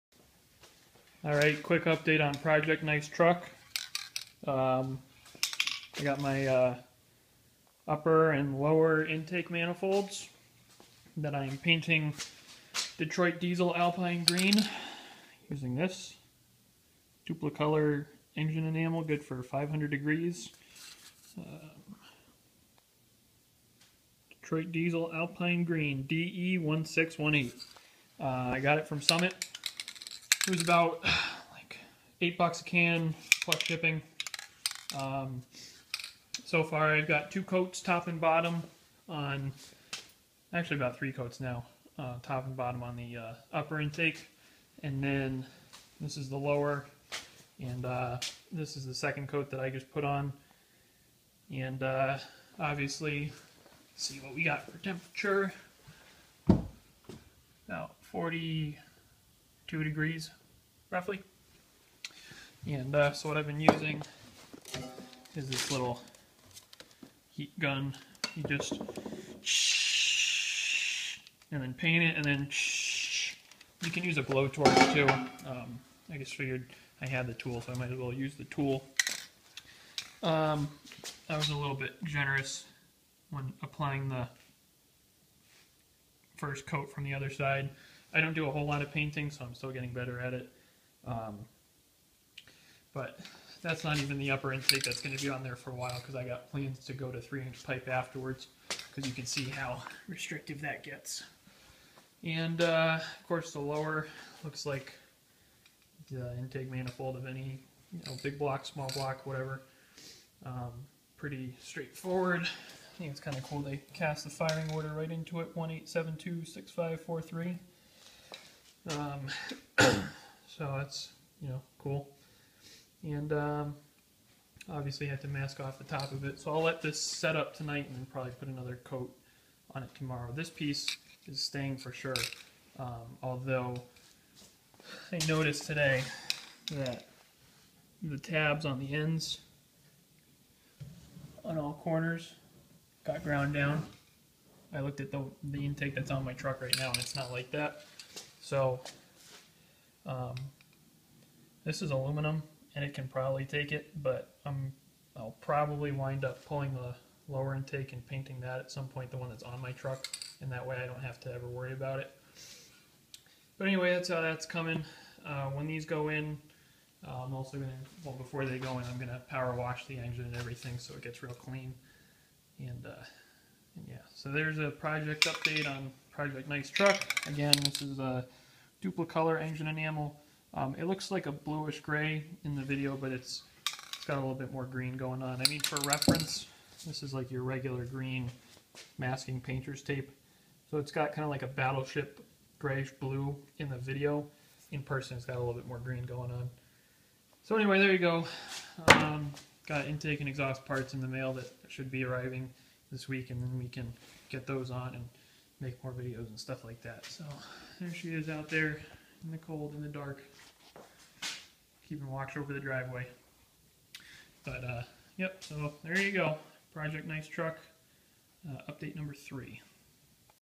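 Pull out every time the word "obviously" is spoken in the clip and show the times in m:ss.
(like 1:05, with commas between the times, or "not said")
0:52, 2:04.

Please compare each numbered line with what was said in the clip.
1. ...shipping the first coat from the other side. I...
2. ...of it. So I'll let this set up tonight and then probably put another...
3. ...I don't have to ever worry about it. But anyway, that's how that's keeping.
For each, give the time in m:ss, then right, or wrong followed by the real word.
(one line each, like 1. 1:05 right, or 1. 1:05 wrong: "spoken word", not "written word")
1. 1:23 wrong: "applying", not "shipping"
2. 2:06 right
3. 2:40 wrong: "coming", not "keeping".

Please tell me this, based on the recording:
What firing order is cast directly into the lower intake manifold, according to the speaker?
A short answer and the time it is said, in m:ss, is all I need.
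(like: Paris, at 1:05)
18726543, at 1:55.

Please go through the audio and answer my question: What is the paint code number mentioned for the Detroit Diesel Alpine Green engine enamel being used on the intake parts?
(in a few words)
DE1618.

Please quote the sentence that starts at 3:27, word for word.
So there she is out there in the cold, in the dark, keeping watch over the driveway.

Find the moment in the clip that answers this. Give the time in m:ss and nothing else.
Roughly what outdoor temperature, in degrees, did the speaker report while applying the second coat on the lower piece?
0:58.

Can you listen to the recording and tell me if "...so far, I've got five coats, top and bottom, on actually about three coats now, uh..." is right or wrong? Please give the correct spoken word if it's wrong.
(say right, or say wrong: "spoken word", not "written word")
wrong: "two", not "five".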